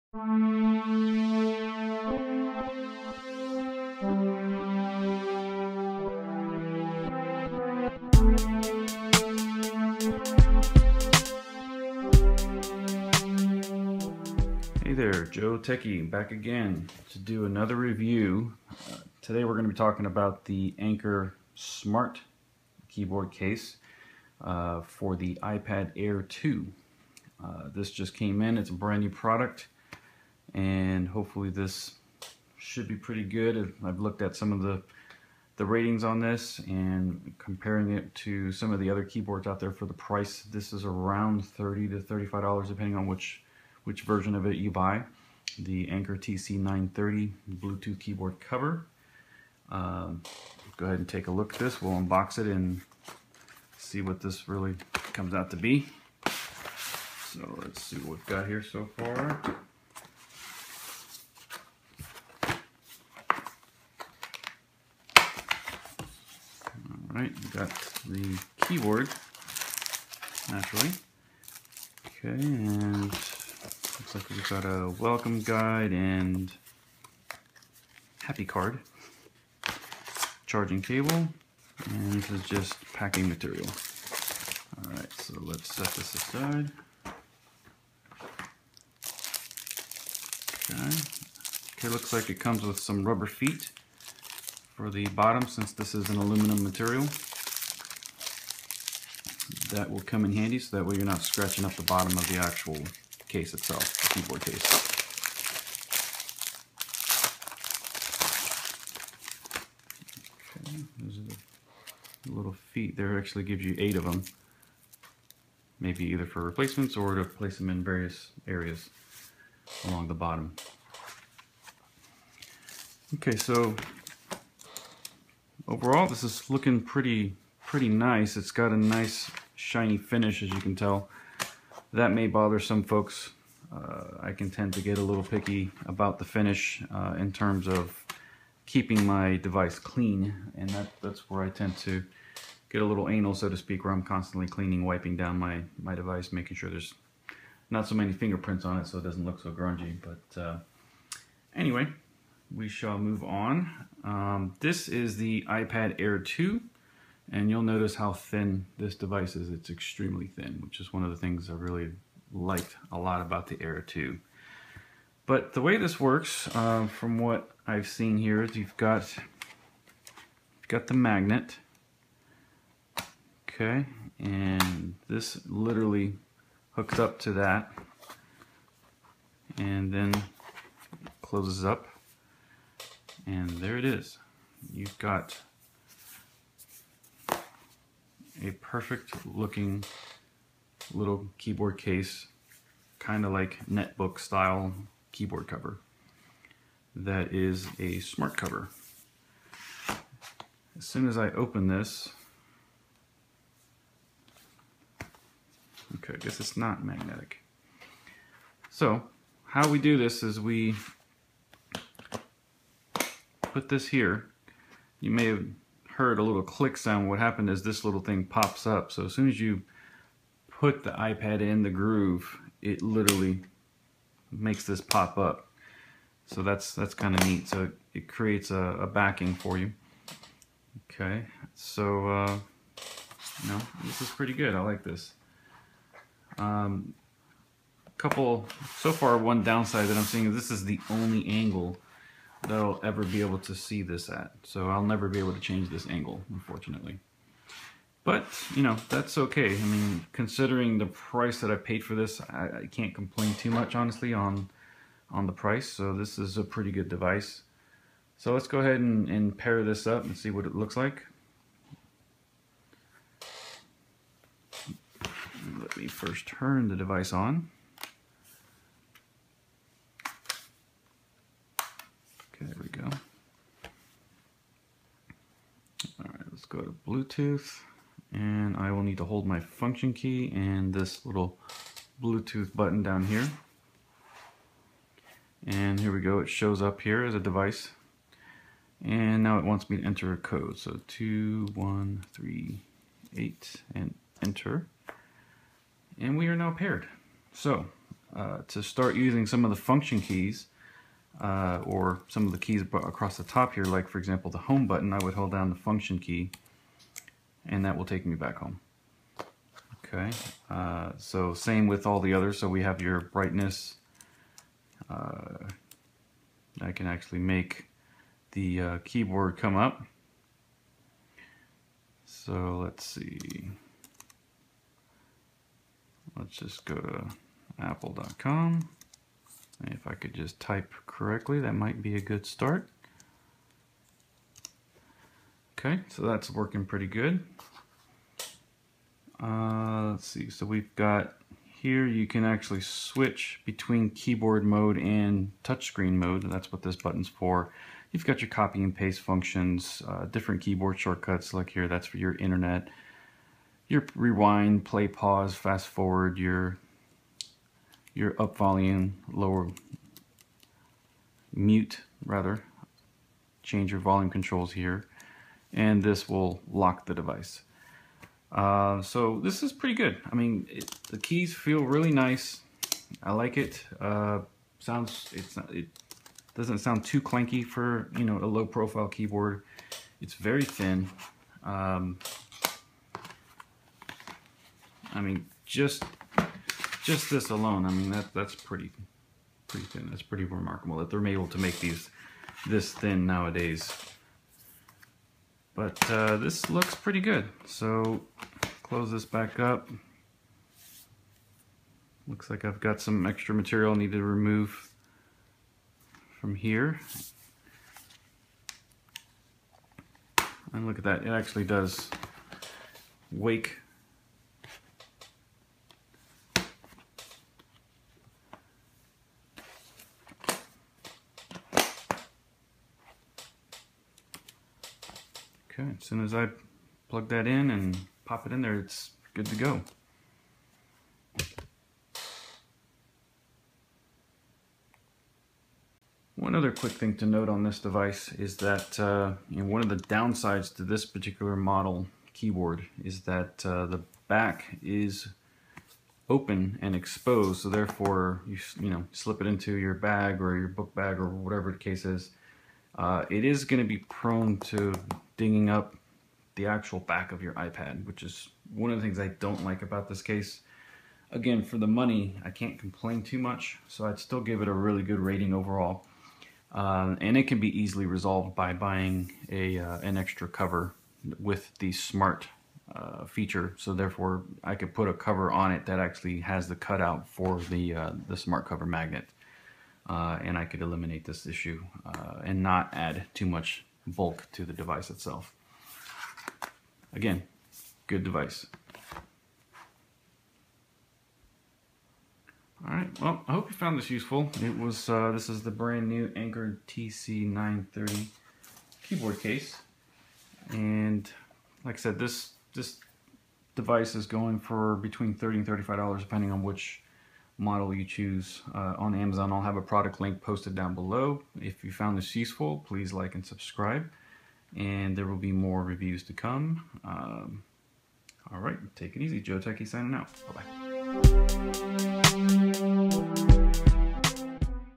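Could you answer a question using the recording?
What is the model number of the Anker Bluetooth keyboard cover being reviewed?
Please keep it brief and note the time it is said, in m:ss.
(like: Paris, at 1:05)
TC930, at 0:45.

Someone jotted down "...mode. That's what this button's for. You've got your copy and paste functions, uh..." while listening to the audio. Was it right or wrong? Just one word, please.
right.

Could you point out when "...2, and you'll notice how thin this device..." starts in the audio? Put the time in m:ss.
2:36.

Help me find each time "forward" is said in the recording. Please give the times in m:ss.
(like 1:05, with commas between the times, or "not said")
5:55.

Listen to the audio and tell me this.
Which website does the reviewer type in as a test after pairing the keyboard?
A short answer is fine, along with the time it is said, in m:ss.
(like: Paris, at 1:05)
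apple.com, at 5:27.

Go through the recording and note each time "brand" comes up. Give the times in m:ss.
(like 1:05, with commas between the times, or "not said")
0:28, 8:15.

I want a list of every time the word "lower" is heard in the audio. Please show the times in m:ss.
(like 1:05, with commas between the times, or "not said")
5:59.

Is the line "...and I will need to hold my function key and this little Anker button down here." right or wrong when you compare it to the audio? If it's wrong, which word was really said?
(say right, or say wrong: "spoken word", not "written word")
wrong: "Bluetooth", not "Anker".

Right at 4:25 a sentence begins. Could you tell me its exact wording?
Let me first turn the device on.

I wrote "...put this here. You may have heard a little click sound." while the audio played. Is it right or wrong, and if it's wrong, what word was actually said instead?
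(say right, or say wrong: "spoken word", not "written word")
right.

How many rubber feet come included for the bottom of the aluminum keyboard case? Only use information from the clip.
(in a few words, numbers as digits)
8.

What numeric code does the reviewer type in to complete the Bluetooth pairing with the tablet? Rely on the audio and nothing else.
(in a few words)
2138.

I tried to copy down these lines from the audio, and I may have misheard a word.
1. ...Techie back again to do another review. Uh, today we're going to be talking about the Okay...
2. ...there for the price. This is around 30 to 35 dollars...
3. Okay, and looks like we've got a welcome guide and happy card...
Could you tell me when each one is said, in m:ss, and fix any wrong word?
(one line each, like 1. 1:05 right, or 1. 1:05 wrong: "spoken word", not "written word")
1. 0:15 wrong: "Anker", not "Okay"
2. 0:39 right
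3. 1:12 right.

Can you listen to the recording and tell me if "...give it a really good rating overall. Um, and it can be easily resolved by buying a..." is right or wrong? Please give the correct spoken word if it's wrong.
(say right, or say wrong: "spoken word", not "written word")
right.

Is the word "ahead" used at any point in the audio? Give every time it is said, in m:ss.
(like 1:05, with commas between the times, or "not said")
0:50, 4:18.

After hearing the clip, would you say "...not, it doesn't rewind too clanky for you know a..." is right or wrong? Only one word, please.
wrong.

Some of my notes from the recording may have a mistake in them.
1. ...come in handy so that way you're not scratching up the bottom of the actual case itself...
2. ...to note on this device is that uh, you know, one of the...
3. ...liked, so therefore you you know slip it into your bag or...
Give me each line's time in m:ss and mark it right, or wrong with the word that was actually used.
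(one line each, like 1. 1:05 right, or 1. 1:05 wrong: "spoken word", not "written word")
1. 1:40 right
2. 7:16 right
3. 7:26 wrong: "exposed", not "liked".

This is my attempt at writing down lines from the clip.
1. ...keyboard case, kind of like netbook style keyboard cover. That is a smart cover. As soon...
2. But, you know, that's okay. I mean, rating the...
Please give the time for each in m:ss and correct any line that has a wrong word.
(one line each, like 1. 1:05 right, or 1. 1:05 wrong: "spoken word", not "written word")
1. 3:11 right
2. 4:08 wrong: "considering", not "rating".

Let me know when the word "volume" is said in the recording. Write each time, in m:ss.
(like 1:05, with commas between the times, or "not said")
5:58, 6:03.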